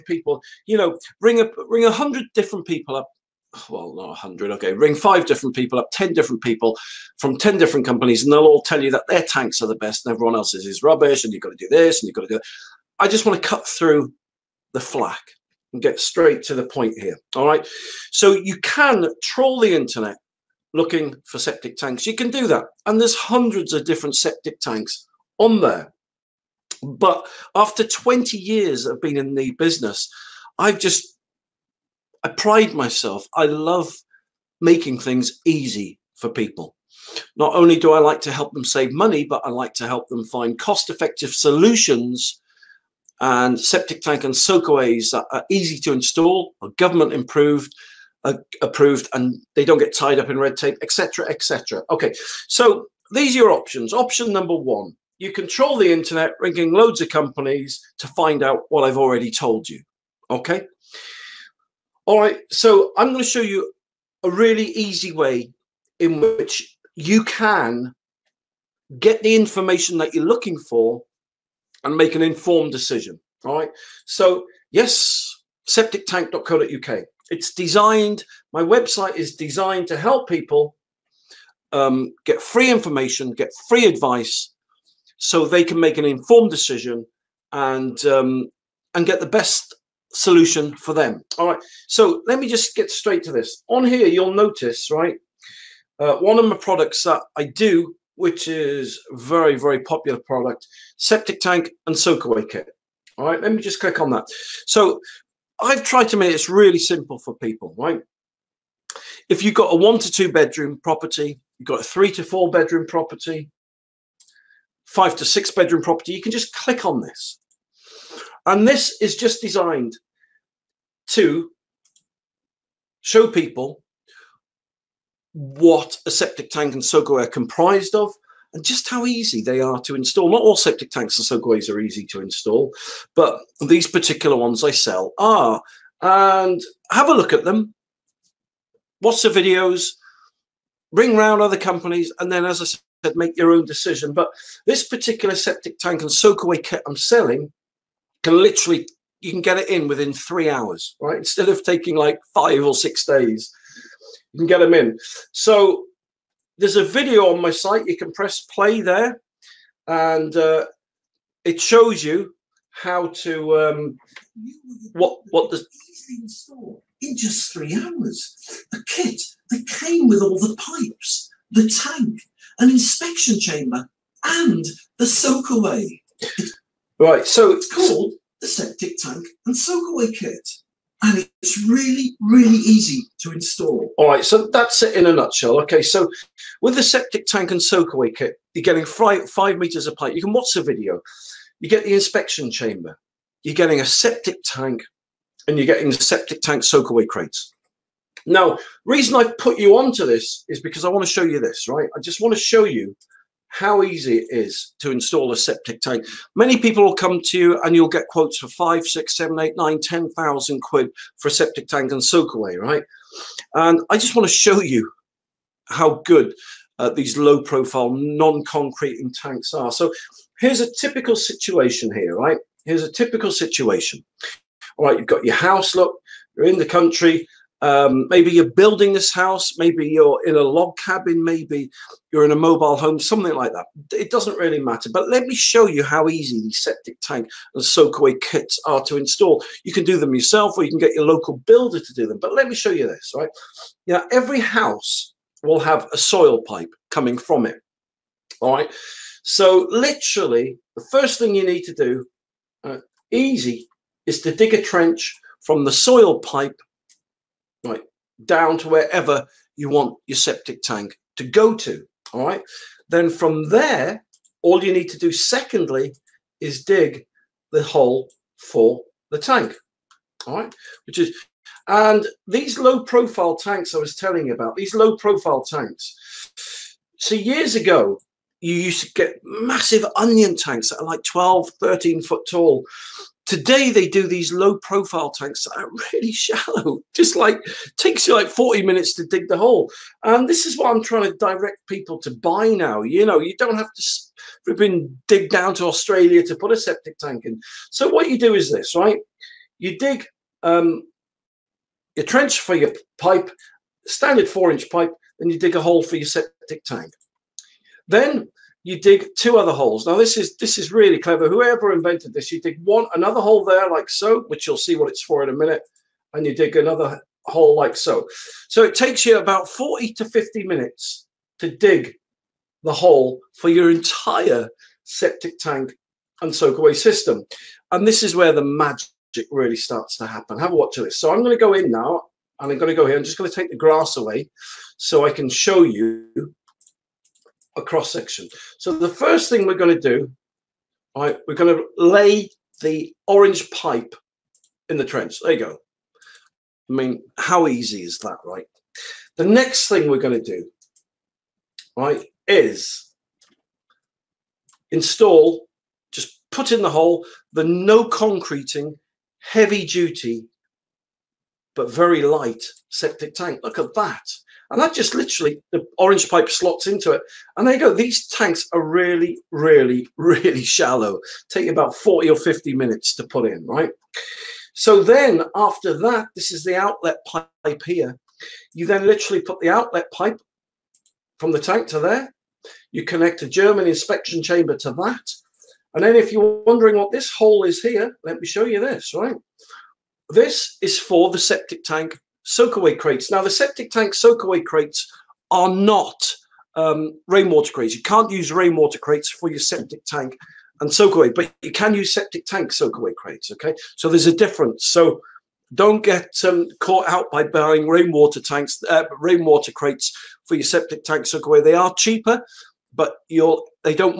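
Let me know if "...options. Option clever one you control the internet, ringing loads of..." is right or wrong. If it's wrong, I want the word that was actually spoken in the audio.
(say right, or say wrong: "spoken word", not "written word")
wrong: "number", not "clever".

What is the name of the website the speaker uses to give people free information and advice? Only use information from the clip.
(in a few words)
septictank.co.uk.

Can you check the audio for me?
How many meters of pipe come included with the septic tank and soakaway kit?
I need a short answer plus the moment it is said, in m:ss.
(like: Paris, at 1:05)
5 meters, at 3:09.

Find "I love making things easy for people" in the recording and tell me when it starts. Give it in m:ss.
0:33.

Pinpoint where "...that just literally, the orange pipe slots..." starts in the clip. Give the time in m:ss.
6:04.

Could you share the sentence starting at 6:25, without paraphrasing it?
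And then if you're wondering what this hole is here, let me show you this, right?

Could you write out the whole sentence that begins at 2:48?
a kit that came with all the pipes, the tank, an inspection chamber, and the soakaway.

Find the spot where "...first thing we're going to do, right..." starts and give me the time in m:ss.
5:38.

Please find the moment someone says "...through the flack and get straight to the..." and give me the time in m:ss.
0:13.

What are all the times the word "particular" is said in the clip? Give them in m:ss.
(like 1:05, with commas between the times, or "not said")
2:13, 2:24.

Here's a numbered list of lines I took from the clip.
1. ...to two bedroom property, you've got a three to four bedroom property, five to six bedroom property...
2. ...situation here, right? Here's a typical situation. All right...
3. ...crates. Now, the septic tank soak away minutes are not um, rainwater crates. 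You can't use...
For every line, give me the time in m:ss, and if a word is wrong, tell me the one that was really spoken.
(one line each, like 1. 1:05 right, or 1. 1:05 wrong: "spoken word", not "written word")
1. 1:49 right
2. 3:41 right
3. 6:32 wrong: "crates", not "minutes".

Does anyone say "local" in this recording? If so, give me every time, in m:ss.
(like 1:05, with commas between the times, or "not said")
4:01.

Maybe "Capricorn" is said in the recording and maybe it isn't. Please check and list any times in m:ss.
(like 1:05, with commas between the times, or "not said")
not said.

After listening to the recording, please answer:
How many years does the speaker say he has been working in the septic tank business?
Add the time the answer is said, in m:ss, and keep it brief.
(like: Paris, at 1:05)
20, at 0:27.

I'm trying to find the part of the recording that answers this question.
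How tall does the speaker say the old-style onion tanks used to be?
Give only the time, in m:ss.
4:41.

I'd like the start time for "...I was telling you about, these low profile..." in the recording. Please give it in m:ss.
4:33.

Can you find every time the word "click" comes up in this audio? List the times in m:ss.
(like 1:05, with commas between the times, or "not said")
1:43, 1:56.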